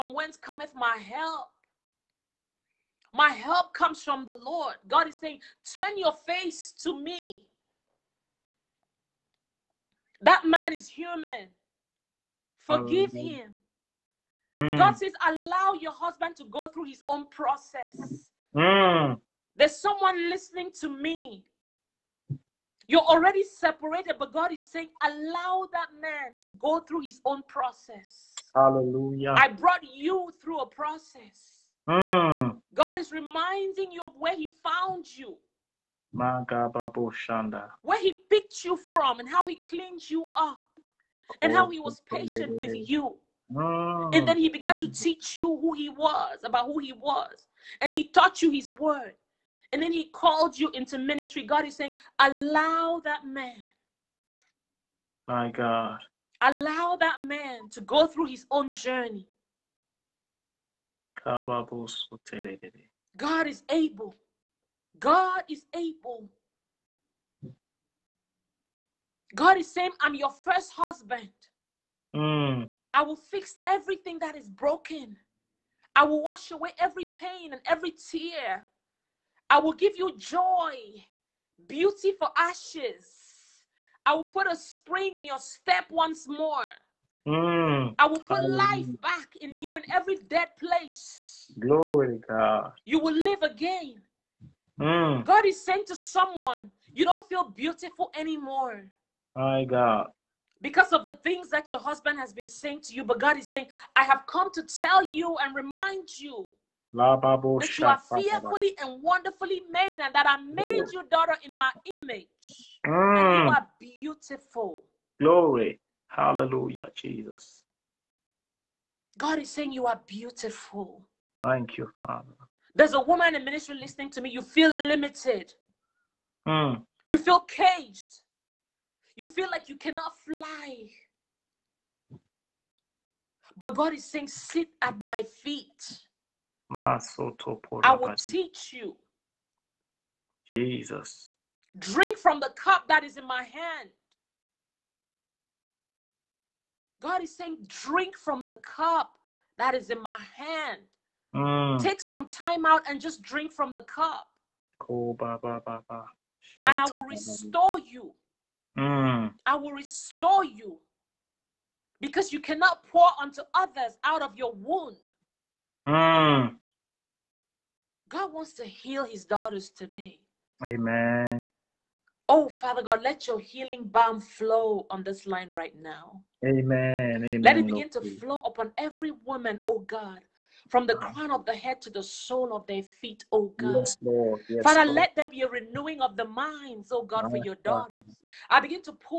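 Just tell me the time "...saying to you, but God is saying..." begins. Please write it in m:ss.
1:42.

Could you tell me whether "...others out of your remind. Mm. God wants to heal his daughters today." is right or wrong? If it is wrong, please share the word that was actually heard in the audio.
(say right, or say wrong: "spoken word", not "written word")
wrong: "wound", not "remind".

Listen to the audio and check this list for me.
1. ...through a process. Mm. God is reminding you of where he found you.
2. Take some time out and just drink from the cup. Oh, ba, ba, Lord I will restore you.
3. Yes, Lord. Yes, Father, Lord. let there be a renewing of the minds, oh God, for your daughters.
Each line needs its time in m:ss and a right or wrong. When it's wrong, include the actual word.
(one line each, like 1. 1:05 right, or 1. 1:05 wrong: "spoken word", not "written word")
1. 0:30 right
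2. 2:31 wrong: "And", not "Lord"
3. 3:03 right.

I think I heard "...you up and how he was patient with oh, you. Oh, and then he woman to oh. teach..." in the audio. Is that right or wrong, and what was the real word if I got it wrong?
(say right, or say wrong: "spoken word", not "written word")
wrong: "began", not "woman".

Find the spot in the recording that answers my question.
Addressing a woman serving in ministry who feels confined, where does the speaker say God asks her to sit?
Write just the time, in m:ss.
2:14.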